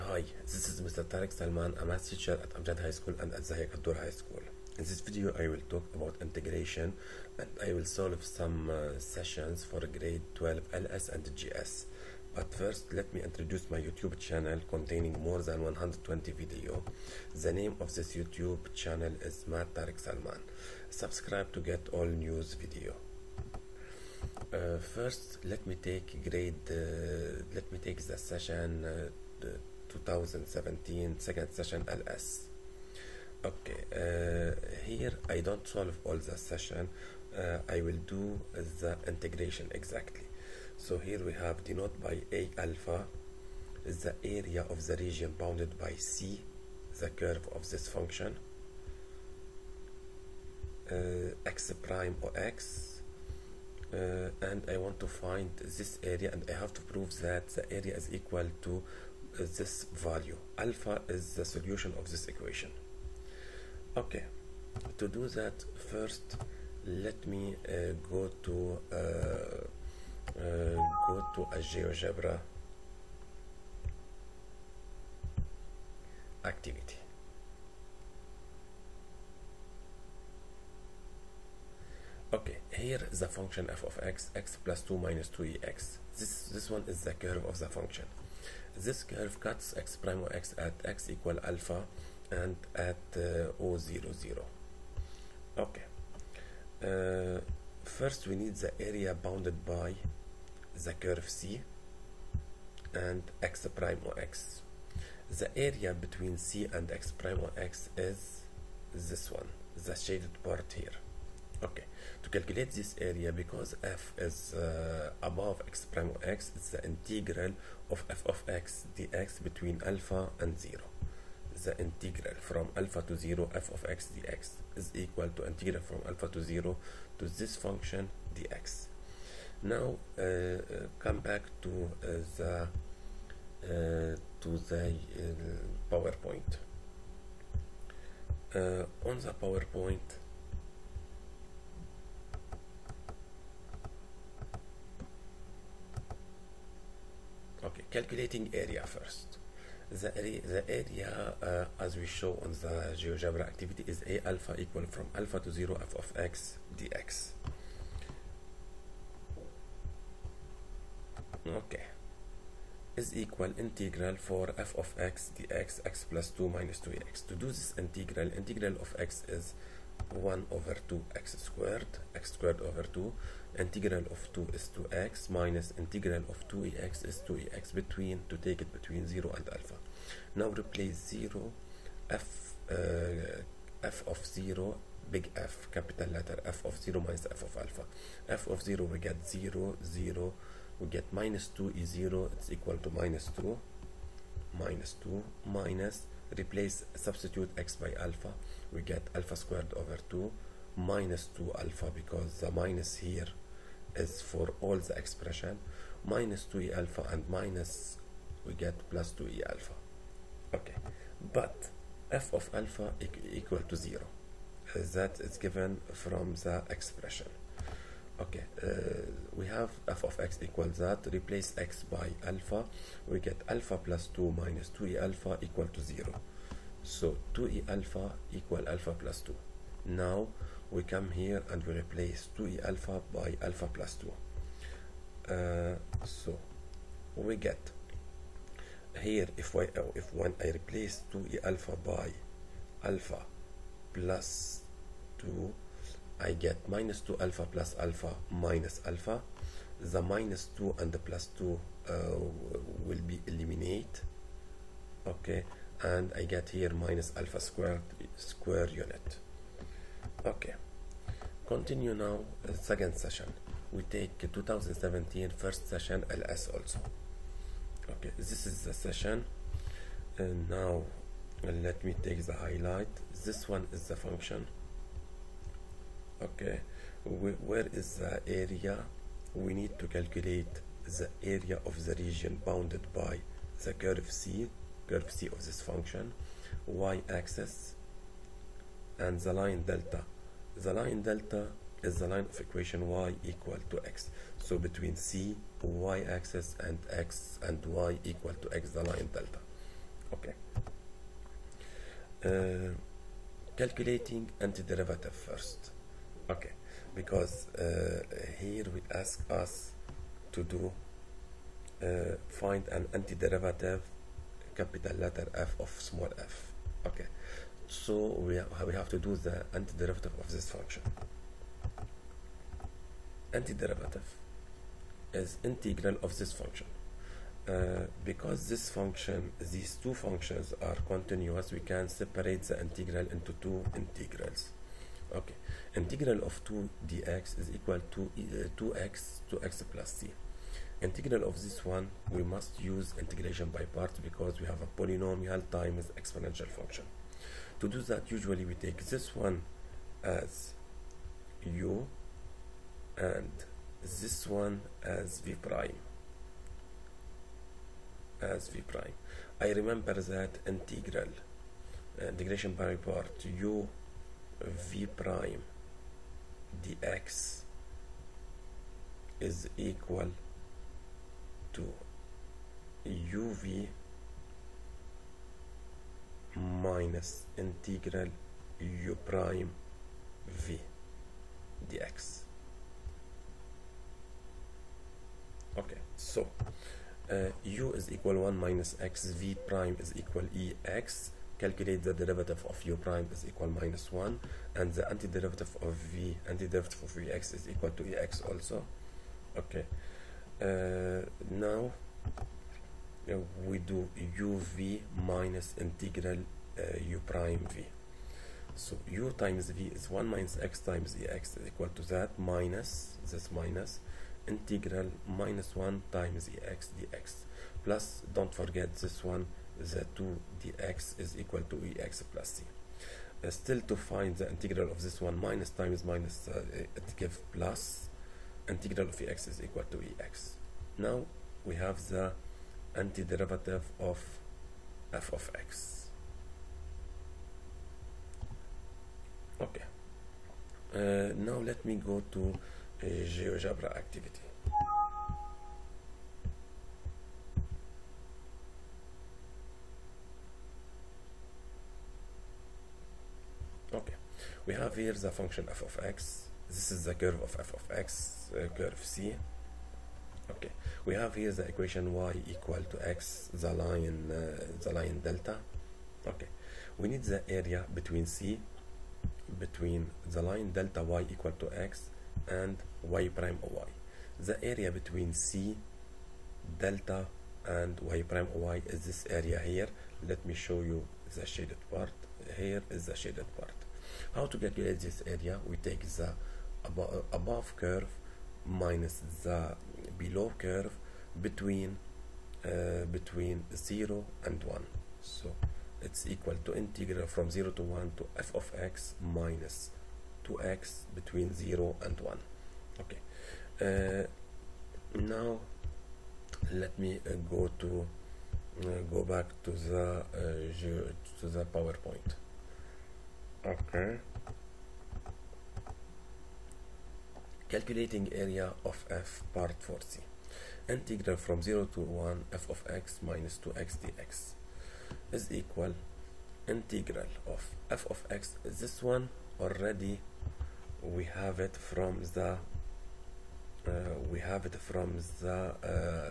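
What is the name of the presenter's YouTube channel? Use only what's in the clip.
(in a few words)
Math Tarek Salman.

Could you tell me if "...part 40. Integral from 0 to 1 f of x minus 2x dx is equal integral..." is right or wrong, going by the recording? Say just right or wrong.
right.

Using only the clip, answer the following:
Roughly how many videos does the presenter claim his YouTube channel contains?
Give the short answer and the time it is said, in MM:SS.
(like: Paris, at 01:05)
more than 120, at 00:15.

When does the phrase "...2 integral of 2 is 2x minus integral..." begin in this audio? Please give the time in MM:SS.
02:52.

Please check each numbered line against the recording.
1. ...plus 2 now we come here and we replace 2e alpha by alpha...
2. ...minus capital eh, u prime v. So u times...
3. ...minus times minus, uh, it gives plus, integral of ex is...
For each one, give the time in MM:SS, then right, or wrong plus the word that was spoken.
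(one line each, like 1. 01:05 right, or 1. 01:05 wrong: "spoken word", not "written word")
1. 03:48 right
2. 06:44 wrong: "integral", not "capital"
3. 07:05 right.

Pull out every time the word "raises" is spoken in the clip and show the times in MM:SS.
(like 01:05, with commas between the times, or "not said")
not said.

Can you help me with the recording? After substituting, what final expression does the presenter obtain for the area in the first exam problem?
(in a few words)
minus alpha squared.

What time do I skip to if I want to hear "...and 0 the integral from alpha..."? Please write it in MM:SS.
02:00.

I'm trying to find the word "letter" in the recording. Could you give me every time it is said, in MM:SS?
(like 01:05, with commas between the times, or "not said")
03:06, 05:14.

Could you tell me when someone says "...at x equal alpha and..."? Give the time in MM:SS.
01:30.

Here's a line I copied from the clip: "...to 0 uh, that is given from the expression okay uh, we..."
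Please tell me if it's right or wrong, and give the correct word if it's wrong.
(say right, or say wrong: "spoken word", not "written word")
right.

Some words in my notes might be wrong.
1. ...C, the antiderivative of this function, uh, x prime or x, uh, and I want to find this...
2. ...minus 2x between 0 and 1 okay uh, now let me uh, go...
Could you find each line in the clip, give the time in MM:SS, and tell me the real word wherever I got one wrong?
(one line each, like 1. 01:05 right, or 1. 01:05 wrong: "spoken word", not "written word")
1. 00:45 wrong: "curve", not "antiderivative"
2. 08:19 right.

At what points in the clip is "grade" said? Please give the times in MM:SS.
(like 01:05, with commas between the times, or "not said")
00:09, 00:26.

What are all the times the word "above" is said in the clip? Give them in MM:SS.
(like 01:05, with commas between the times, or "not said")
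01:55, 08:07.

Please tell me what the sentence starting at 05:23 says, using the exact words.
Antiderivative is integral of this function.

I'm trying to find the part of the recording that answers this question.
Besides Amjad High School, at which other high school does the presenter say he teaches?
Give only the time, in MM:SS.
00:03.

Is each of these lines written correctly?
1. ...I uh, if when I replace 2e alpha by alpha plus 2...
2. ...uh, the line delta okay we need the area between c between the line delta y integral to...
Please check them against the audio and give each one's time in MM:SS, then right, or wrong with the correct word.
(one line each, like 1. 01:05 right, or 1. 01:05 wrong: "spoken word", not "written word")
1. 03:59 right
2. 07:44 wrong: "equal", not "integral".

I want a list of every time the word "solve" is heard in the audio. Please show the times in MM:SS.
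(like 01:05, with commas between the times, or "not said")
00:07, 00:35.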